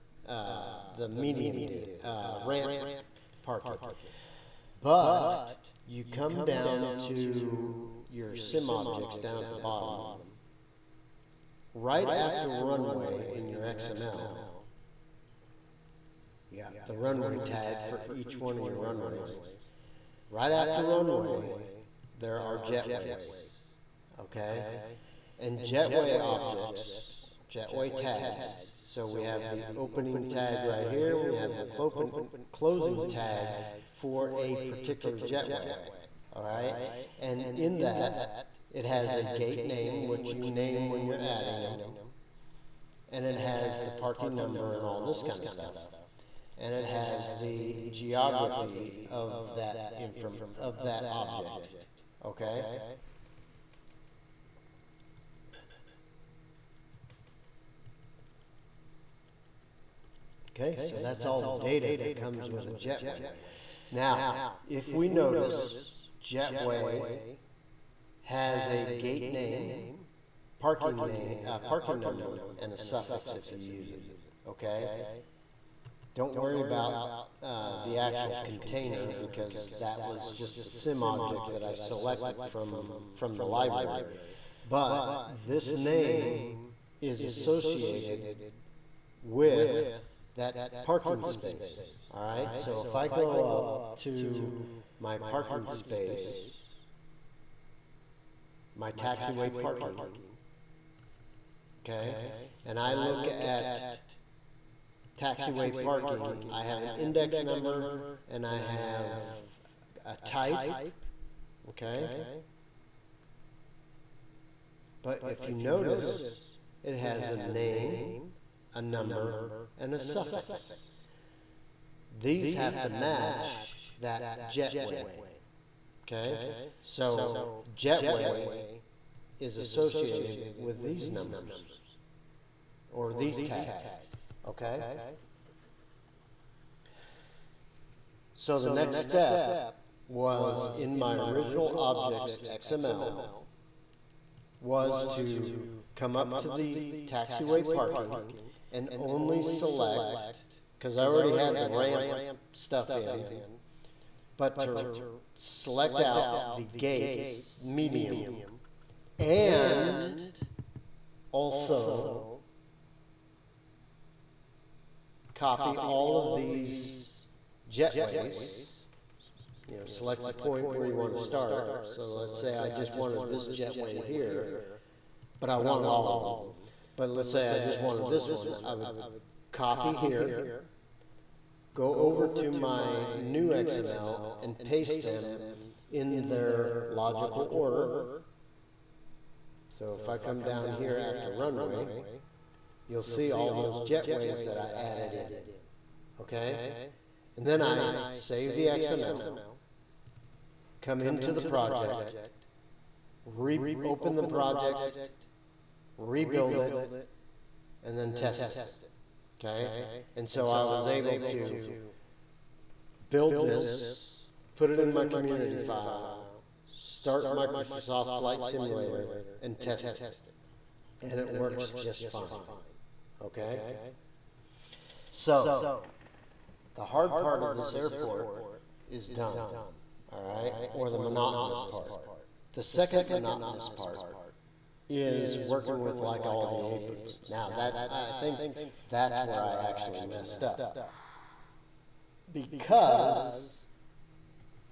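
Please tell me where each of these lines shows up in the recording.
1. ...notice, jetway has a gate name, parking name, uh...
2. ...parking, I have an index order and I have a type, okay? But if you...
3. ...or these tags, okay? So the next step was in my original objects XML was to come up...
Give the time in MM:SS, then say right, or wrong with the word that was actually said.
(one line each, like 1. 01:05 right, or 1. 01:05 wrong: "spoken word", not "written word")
1. 01:05 right
2. 01:45 wrong: "number", not "order"
3. 02:12 right.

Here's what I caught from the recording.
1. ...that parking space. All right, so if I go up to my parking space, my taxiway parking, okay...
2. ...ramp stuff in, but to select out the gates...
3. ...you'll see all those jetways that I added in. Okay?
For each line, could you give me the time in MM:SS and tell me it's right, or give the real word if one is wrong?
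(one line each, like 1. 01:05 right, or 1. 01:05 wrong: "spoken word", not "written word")
1. 01:30 right
2. 02:31 right
3. 03:12 right.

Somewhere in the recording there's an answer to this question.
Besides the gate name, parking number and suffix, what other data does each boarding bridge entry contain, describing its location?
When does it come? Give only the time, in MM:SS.
00:47.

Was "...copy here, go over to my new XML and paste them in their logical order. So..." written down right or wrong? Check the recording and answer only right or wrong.
right.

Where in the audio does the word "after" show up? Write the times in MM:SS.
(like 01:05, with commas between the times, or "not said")
00:12, 00:20, 03:10.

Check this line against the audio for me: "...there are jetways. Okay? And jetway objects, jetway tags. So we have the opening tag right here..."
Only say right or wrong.
right.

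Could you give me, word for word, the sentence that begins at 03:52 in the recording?
The second monotonous part is working with like all the aprons.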